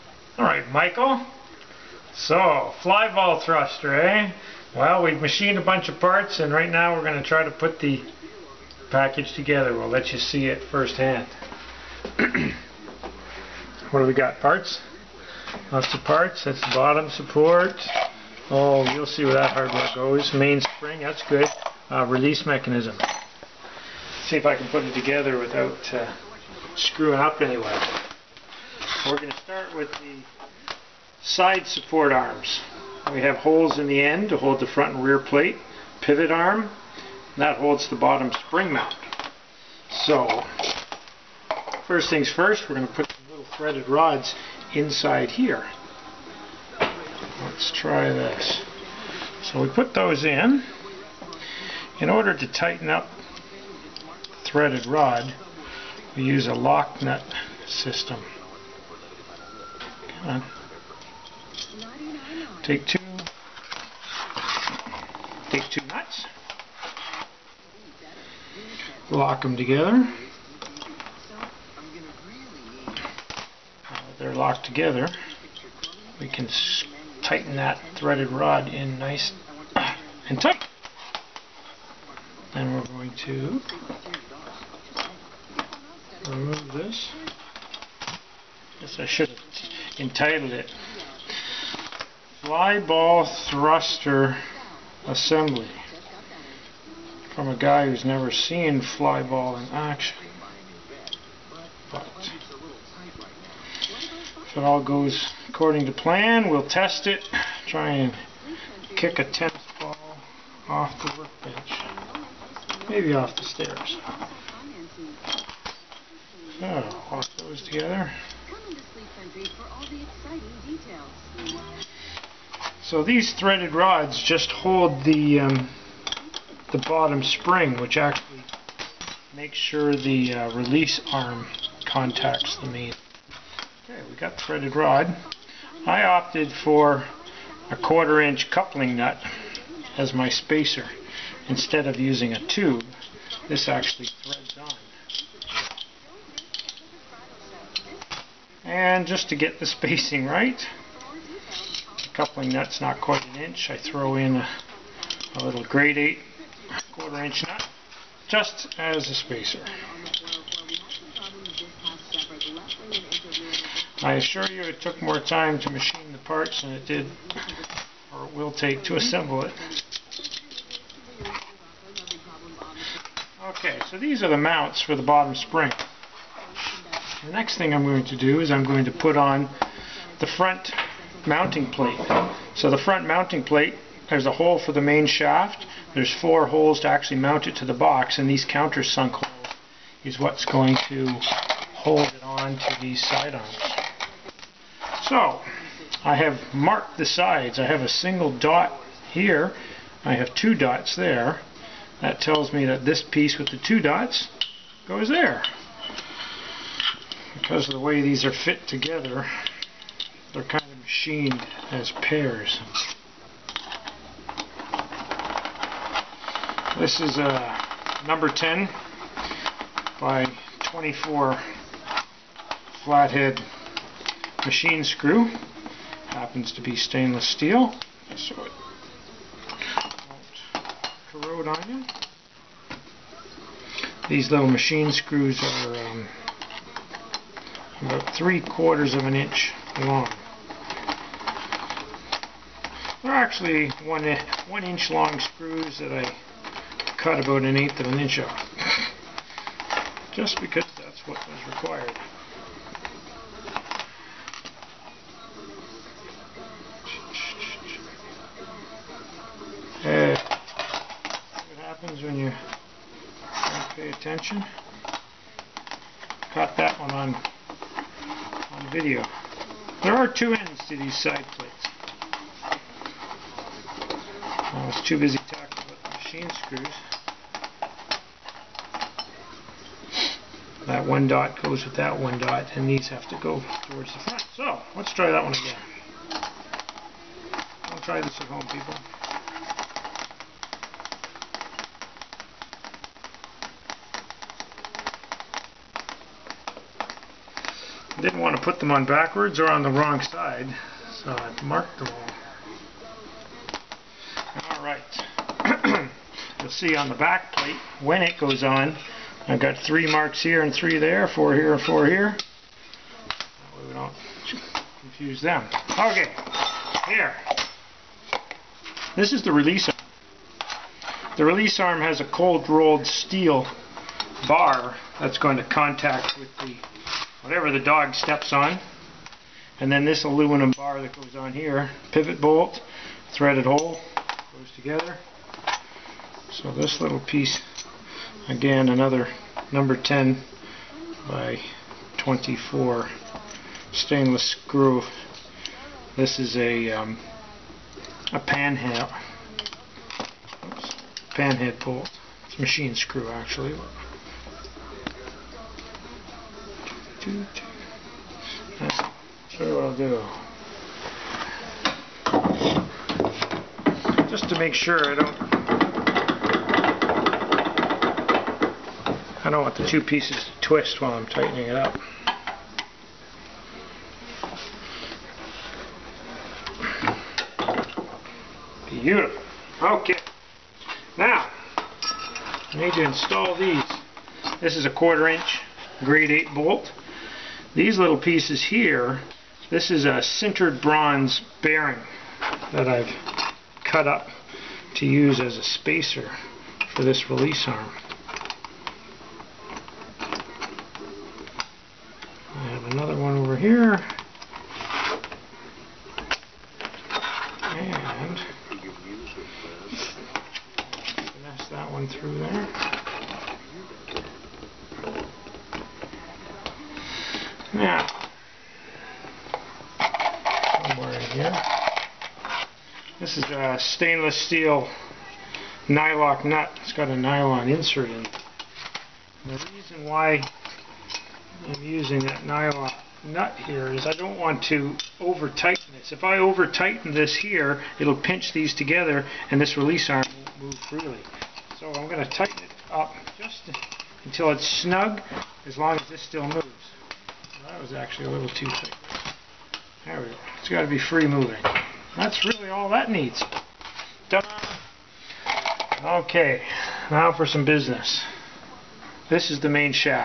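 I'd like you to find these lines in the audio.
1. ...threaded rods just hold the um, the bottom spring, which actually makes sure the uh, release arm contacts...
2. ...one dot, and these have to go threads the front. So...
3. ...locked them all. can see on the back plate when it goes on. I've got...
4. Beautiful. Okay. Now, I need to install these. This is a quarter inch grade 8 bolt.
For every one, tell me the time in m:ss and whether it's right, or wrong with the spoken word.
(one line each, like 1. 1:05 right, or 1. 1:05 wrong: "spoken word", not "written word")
1. 2:03 right
2. 4:41 wrong: "towards", not "threads"
3. 5:01 wrong: "marked", not "locked"
4. 6:18 right.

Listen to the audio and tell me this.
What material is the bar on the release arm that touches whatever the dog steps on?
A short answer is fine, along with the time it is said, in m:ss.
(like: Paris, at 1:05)
cold rolled steel, at 5:22.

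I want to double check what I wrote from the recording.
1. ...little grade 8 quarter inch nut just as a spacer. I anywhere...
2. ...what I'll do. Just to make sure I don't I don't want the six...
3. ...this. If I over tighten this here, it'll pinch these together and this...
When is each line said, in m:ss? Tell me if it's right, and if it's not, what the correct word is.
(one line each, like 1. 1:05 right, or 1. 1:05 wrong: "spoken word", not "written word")
1. 2:35 wrong: "assure", not "anywhere"
2. 5:59 wrong: "two", not "six"
3. 7:15 right.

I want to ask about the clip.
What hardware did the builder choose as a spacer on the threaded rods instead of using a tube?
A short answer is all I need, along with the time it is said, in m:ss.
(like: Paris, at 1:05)
quarter inch coupling nut, at 2:17.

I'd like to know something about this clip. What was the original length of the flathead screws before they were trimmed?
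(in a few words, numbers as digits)
1 inch.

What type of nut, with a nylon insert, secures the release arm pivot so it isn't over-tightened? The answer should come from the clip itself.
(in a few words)
nylock nut.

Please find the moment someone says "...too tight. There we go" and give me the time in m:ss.
7:28.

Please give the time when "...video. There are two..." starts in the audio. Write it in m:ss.
4:28.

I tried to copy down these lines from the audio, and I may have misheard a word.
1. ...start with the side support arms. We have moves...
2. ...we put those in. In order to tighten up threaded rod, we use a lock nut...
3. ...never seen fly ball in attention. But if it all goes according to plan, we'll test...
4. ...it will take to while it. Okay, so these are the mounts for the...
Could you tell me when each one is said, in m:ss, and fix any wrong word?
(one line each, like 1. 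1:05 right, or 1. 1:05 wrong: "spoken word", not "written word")
1. 0:29 wrong: "holes", not "moves"
2. 0:49 right
3. 1:38 wrong: "action", not "attention"
4. 2:48 wrong: "assemble", not "while".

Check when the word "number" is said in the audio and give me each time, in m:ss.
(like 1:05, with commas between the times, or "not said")
3:38, 5:39.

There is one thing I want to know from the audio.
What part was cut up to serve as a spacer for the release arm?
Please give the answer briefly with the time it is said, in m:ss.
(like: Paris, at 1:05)
sintered bronze bearing, at 6:30.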